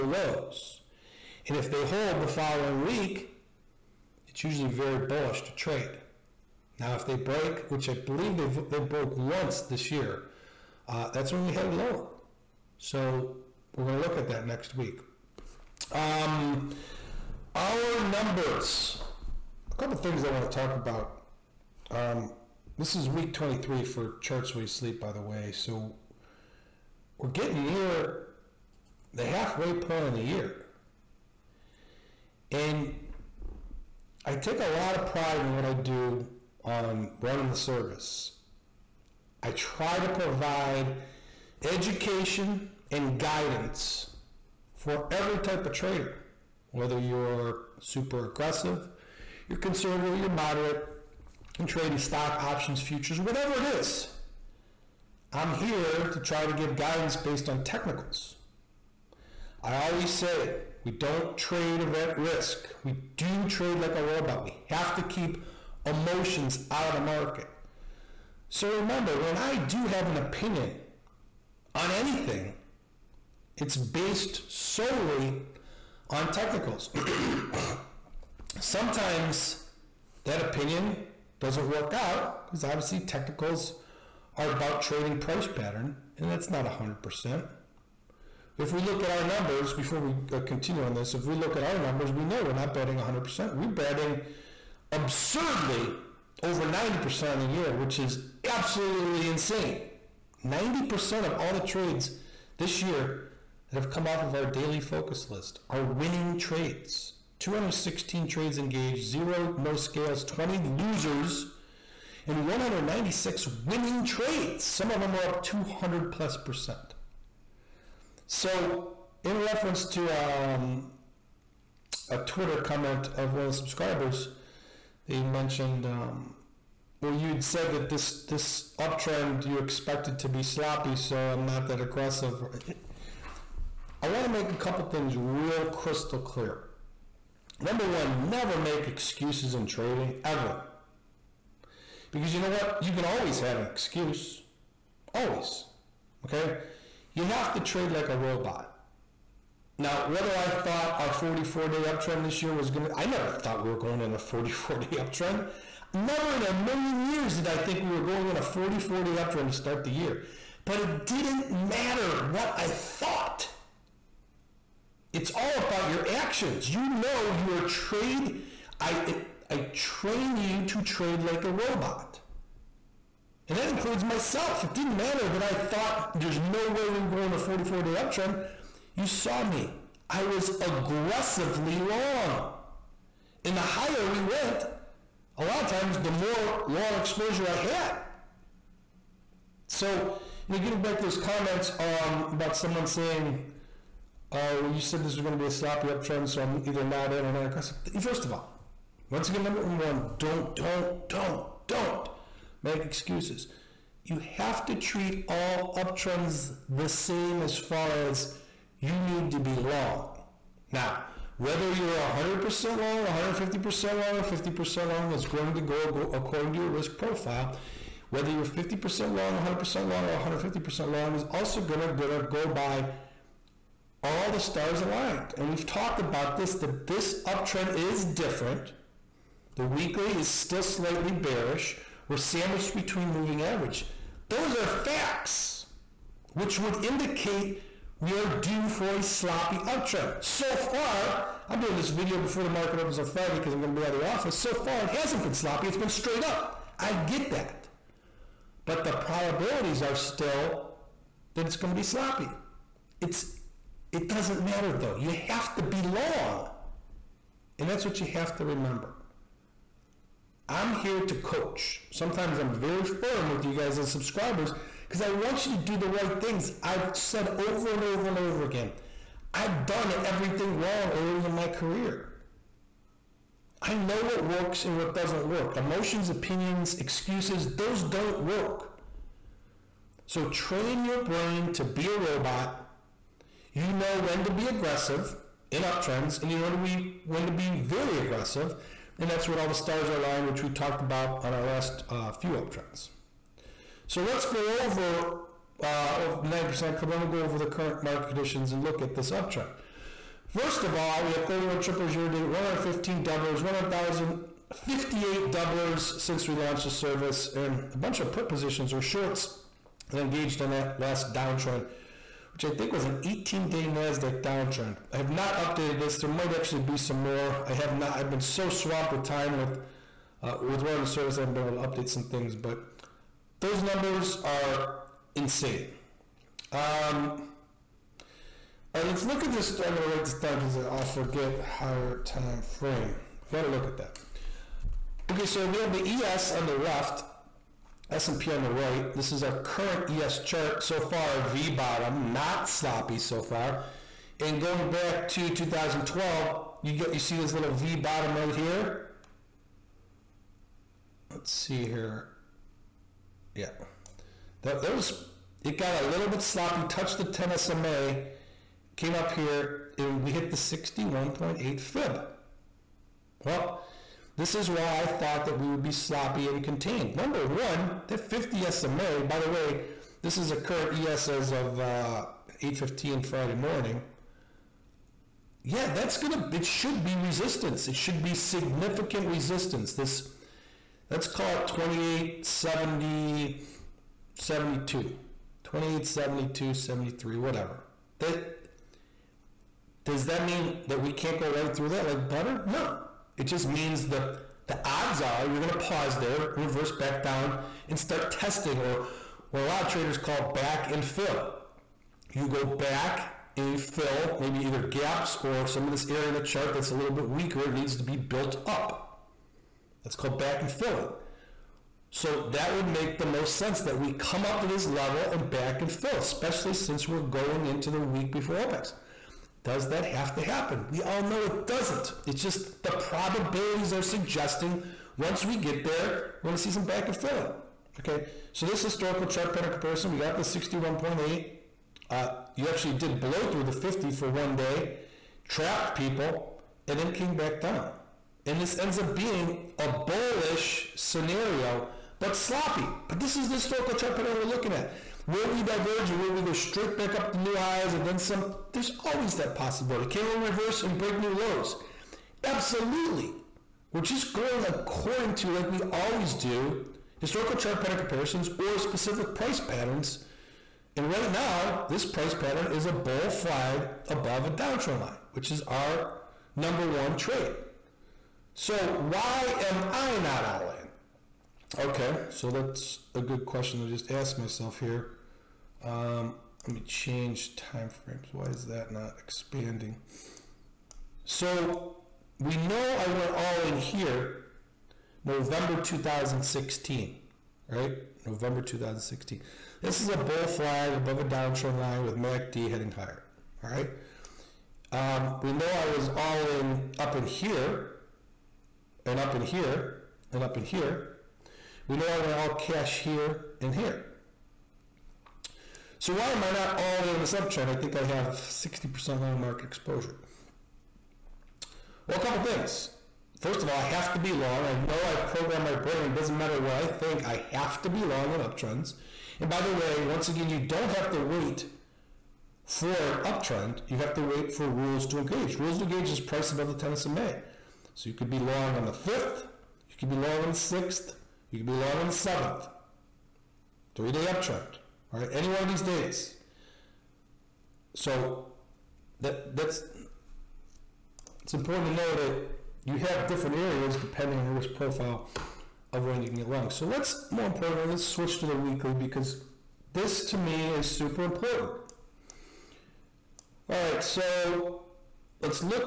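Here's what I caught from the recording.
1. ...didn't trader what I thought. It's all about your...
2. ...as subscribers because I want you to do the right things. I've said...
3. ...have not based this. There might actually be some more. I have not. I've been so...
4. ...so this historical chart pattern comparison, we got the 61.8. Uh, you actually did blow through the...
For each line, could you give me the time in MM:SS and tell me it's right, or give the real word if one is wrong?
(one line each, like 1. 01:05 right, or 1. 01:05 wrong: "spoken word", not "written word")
1. 02:41 wrong: "matter", not "trader"
2. 04:23 right
3. 05:14 wrong: "updated", not "based"
4. 07:08 right.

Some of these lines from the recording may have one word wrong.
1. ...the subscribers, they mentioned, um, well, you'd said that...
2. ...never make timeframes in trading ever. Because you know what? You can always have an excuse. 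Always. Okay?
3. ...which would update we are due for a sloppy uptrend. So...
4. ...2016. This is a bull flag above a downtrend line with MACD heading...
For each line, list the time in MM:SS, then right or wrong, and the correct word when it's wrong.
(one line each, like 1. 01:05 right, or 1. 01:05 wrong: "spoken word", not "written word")
1. 02:03 right
2. 02:18 wrong: "excuses", not "timeframes"
3. 03:56 wrong: "indicate", not "update"
4. 08:08 right.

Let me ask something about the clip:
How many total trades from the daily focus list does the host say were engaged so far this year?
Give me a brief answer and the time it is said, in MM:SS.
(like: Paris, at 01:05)
216, at 01:47.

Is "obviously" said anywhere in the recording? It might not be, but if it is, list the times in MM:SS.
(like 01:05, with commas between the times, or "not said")
01:22.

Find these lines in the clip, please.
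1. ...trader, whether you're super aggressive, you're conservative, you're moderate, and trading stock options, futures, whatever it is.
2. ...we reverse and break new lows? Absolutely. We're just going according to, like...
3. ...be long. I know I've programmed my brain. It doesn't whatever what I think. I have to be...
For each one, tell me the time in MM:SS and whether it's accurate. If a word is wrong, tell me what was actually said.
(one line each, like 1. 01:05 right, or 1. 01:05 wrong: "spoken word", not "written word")
1. 00:45 right
2. 07:30 right
3. 08:33 wrong: "matter", not "whatever".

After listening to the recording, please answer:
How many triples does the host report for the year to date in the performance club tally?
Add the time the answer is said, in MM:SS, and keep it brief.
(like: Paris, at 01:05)
31, at 05:01.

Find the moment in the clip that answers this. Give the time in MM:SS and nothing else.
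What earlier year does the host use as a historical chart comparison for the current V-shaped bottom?
05:45.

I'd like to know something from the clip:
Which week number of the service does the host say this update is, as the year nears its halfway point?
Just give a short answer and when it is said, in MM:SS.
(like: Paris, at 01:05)
23, at 00:23.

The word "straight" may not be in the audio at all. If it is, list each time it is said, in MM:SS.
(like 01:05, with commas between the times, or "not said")
04:05, 07:26.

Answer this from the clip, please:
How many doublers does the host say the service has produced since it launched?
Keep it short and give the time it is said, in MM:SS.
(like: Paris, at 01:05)
1,058, at 05:03.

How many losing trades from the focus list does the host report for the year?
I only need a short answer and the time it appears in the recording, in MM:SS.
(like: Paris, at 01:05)
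20, at 01:50.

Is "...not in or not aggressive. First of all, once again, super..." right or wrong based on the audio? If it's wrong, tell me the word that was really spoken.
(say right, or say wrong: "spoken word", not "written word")
wrong: "number", not "super".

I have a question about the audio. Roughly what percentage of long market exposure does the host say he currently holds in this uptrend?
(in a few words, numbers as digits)
60%.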